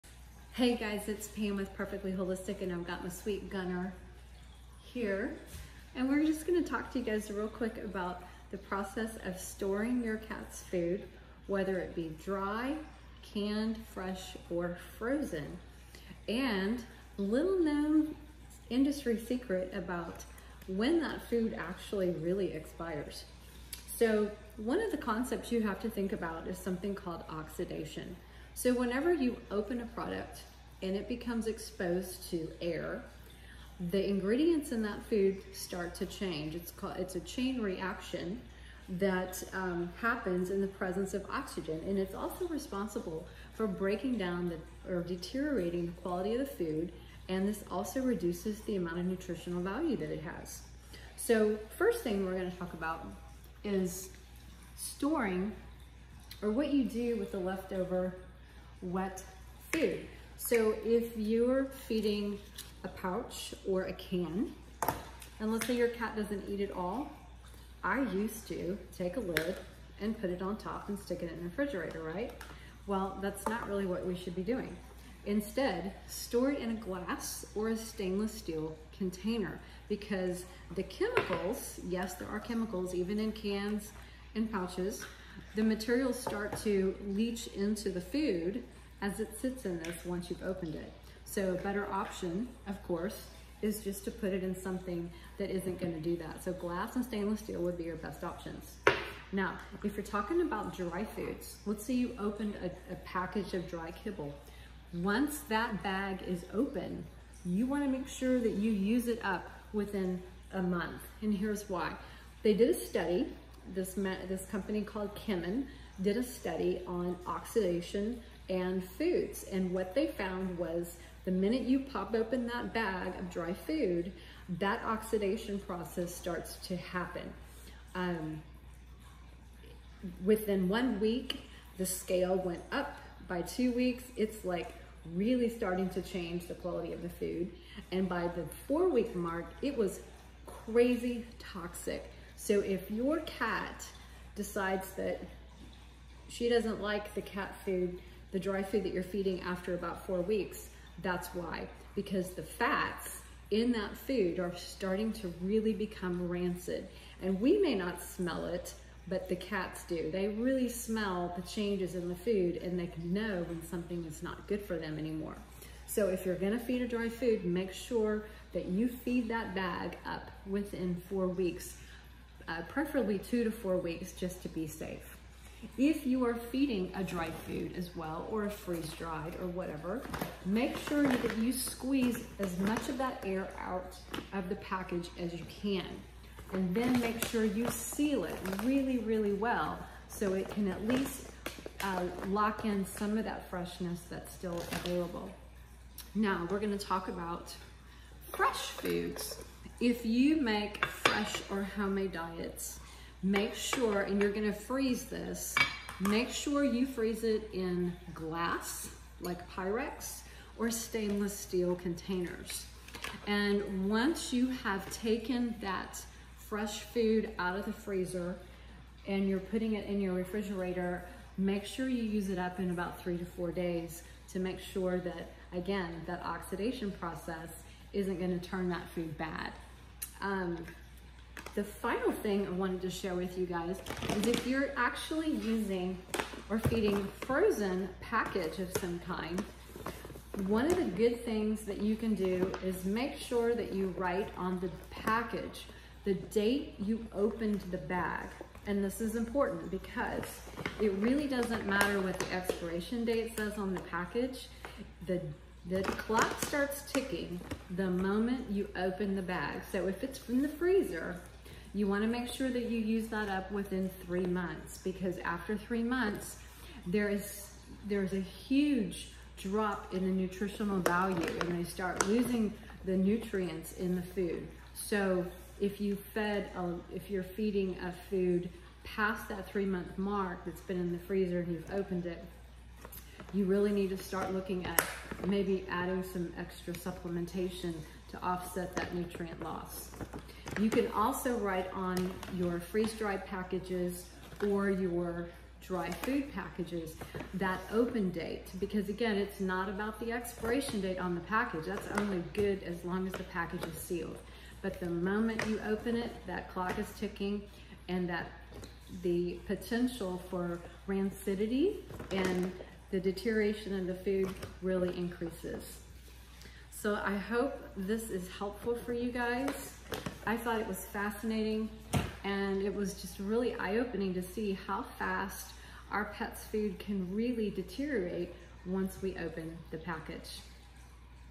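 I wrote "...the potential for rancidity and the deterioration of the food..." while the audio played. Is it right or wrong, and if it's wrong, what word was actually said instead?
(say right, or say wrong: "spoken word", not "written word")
right.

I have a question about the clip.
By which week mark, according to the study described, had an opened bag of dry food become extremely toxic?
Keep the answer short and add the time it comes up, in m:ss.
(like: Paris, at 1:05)
4 weeks, at 2:18.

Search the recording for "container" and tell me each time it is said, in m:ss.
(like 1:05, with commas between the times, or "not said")
1:18, 3:31.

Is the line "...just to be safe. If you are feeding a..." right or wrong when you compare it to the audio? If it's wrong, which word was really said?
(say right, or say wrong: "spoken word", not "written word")
right.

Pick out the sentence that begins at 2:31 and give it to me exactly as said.
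Because the fats in that food are starting to really become rancid.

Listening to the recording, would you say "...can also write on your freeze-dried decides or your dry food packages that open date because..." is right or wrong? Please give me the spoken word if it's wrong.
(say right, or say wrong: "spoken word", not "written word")
wrong: "packages", not "decides".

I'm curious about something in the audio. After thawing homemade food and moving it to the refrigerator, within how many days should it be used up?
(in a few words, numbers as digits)
3 to 4 days.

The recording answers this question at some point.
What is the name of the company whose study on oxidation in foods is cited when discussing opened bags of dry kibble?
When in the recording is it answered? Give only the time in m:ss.
1:55.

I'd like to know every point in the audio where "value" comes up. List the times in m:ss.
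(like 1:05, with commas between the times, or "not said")
0:49, 4:30.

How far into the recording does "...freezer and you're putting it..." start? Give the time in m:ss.
3:37.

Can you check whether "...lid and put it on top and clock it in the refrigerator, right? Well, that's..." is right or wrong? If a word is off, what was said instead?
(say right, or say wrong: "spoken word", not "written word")
wrong: "stick", not "clock".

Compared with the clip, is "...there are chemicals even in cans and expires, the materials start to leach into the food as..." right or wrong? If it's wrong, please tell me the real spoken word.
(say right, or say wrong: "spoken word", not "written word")
wrong: "pouches", not "expires".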